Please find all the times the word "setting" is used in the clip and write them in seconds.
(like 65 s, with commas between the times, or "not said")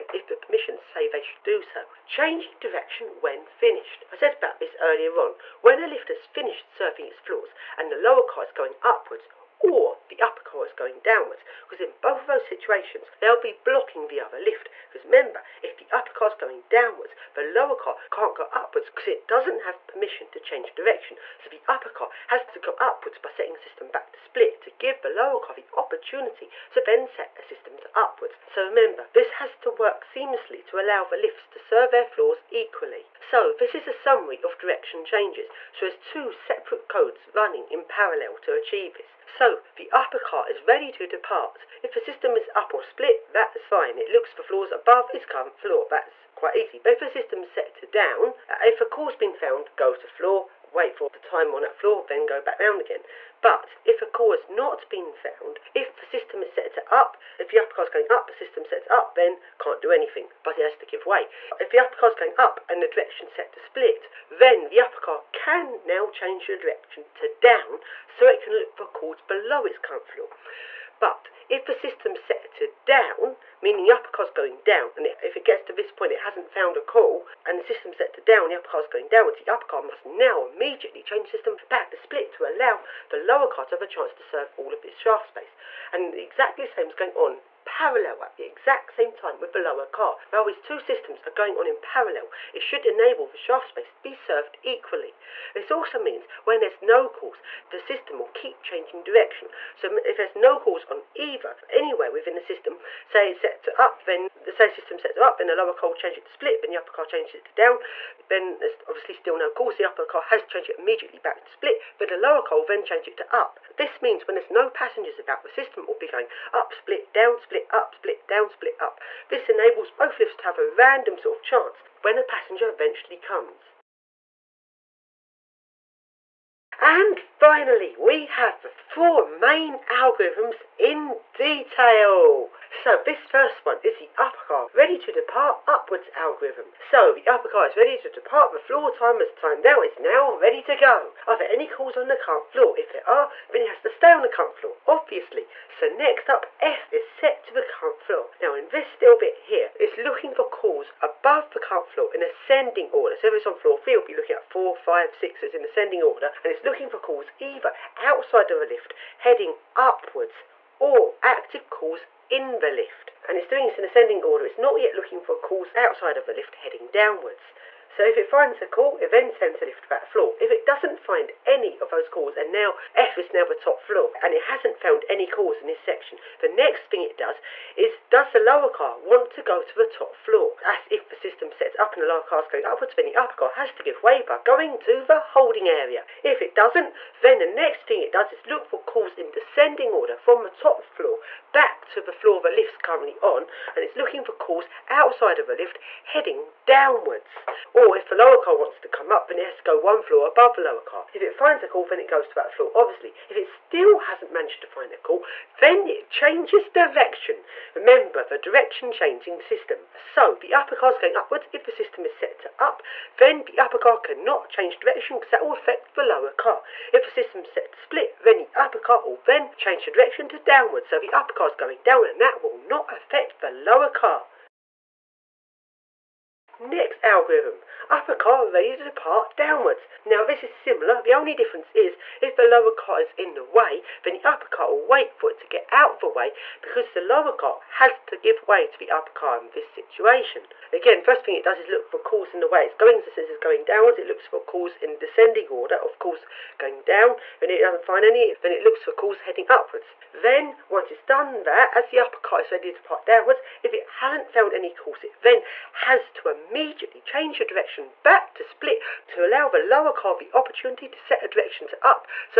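23 s.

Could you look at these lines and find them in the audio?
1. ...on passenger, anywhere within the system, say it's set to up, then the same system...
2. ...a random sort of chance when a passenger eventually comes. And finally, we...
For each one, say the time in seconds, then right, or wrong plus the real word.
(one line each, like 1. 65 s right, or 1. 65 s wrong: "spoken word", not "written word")
1. 100 s wrong: "either", not "passenger"
2. 120 s right.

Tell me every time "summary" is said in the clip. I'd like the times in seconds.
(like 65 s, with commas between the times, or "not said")
33 s.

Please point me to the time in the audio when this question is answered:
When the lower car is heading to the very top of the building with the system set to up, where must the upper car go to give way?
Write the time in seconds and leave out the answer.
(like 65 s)
185 s.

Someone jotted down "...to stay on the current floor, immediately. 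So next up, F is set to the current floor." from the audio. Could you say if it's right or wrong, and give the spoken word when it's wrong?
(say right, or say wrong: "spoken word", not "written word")
wrong: "obviously", not "immediately".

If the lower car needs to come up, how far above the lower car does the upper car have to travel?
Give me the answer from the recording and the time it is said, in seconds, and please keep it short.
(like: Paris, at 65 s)
1 floor, at 199 s.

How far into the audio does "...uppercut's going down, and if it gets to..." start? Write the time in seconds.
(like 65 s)
73 s.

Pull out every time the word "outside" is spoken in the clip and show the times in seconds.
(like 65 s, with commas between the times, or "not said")
157 s, 165 s, 194 s.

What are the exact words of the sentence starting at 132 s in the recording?
So this first one is the upper car ready to depart upwards algorithm.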